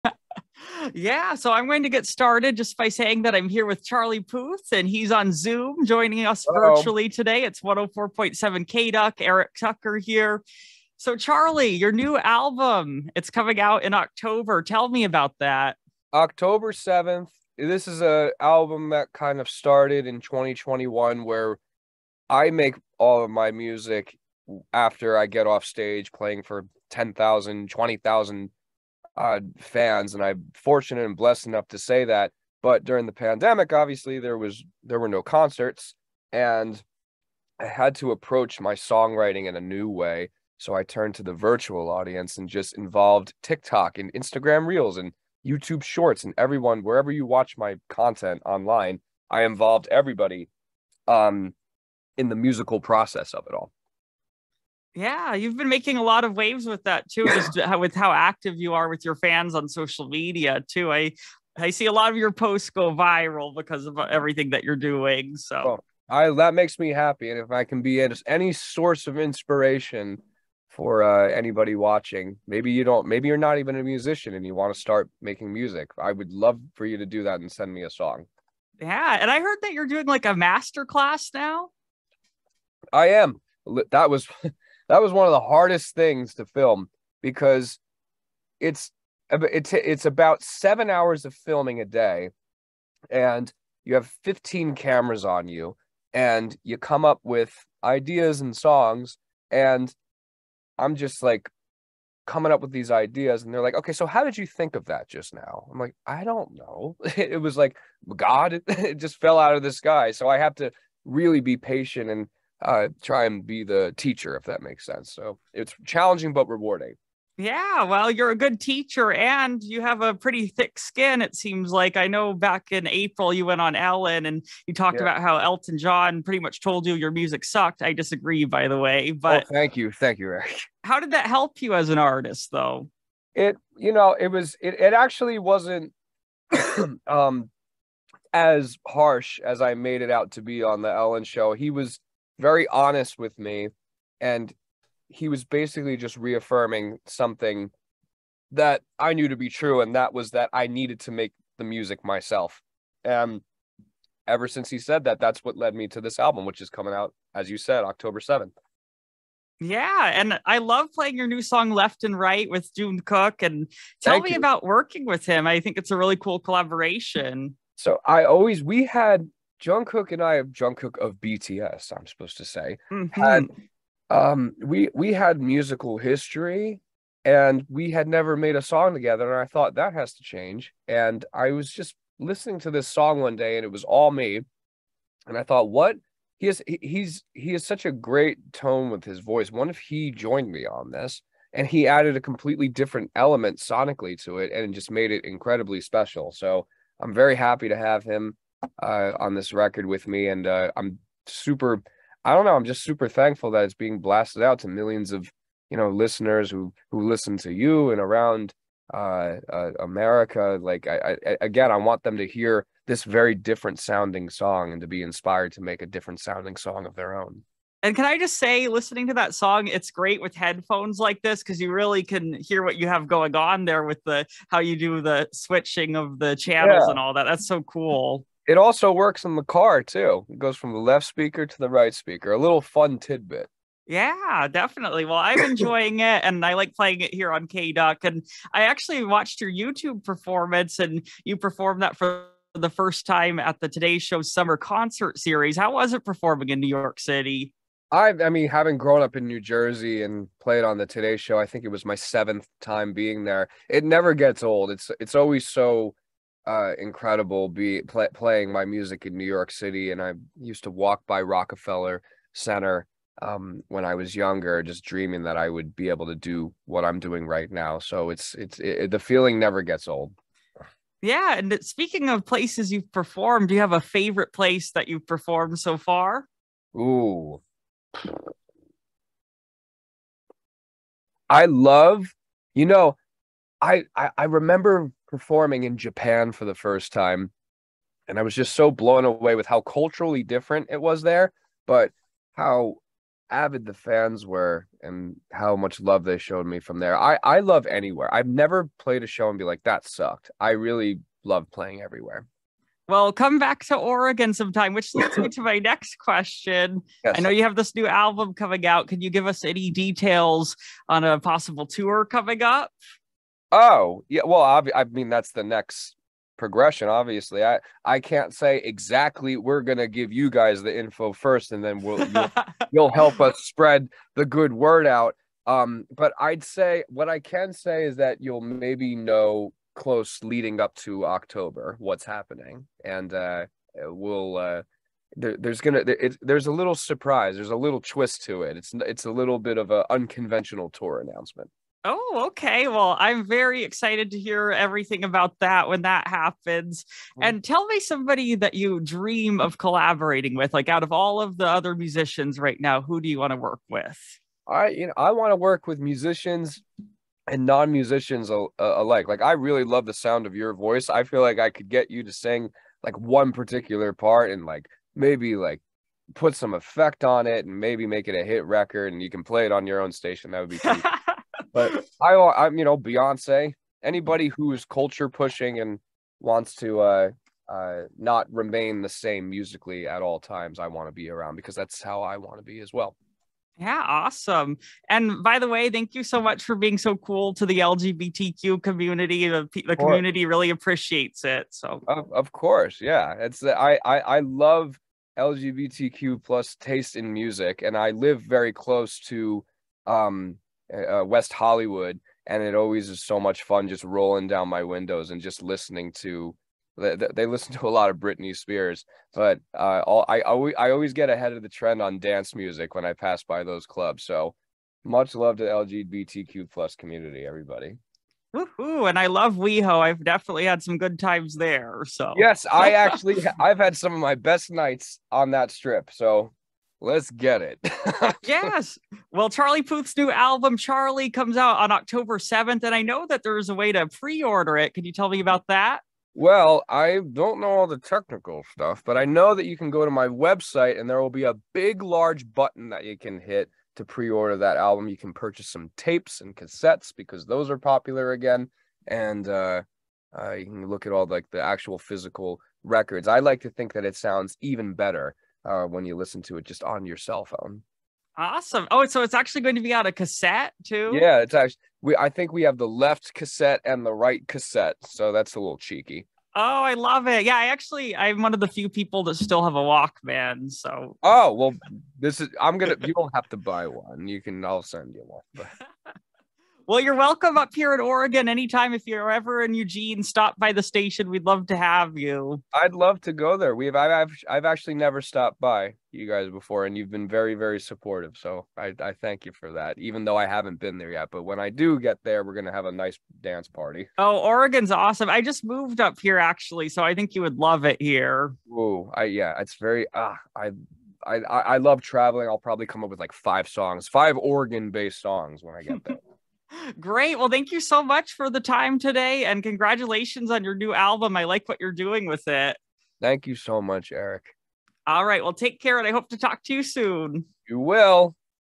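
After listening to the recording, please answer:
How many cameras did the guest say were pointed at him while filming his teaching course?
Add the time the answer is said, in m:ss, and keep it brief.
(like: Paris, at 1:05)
15, at 1:34.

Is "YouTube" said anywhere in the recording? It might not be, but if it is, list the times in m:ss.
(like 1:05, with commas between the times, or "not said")
0:45, 3:59.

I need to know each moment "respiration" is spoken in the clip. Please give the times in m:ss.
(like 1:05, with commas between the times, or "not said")
not said.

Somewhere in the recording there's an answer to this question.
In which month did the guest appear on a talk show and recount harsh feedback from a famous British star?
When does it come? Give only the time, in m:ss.
2:02.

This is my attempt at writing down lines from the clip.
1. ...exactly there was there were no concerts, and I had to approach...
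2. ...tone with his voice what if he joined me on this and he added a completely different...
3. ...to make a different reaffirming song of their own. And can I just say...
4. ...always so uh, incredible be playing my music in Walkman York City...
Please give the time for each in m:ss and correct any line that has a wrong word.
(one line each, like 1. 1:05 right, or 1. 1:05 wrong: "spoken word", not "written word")
1. 0:33 wrong: "obviously", not "exactly"
2. 3:08 right
3. 3:35 wrong: "sounding", not "reaffirming"
4. 4:15 wrong: "New", not "Walkman".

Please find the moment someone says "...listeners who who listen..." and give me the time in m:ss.
3:25.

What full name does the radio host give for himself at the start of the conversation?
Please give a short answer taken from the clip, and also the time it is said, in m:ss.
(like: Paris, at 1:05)
Eric Tucker, at 0:09.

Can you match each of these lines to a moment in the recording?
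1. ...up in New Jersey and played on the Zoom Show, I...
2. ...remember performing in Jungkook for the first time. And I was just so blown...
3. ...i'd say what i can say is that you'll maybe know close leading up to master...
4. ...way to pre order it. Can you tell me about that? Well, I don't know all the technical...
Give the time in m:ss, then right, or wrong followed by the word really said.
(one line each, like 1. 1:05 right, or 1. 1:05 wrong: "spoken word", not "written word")
1. 4:09 wrong: "Today", not "Zoom"
2. 4:44 wrong: "Japan", not "Jungkook"
3. 5:26 wrong: "october", not "master"
4. 7:13 right.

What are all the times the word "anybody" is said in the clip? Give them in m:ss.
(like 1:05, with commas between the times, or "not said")
1:11, 6:13.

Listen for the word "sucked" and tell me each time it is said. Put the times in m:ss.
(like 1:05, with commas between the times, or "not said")
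2:07, 4:59.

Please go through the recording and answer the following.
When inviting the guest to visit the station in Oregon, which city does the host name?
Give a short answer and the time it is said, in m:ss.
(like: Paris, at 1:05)
Eugene, at 7:59.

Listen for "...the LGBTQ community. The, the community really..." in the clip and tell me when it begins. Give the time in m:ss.
6:27.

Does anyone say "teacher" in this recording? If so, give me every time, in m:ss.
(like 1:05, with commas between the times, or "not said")
1:53, 1:58.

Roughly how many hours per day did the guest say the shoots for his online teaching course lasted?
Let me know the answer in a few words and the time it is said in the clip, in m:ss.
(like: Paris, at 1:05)
7 hours, at 1:30.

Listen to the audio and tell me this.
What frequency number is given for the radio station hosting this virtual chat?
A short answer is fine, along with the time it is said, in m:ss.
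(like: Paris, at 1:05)
104.7, at 0:07.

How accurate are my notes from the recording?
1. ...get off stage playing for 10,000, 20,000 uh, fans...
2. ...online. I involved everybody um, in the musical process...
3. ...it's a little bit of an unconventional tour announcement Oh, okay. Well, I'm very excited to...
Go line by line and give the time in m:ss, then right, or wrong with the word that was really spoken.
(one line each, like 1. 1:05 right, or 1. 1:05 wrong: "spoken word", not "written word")
1. 0:25 right
2. 0:48 right
3. 5:38 right.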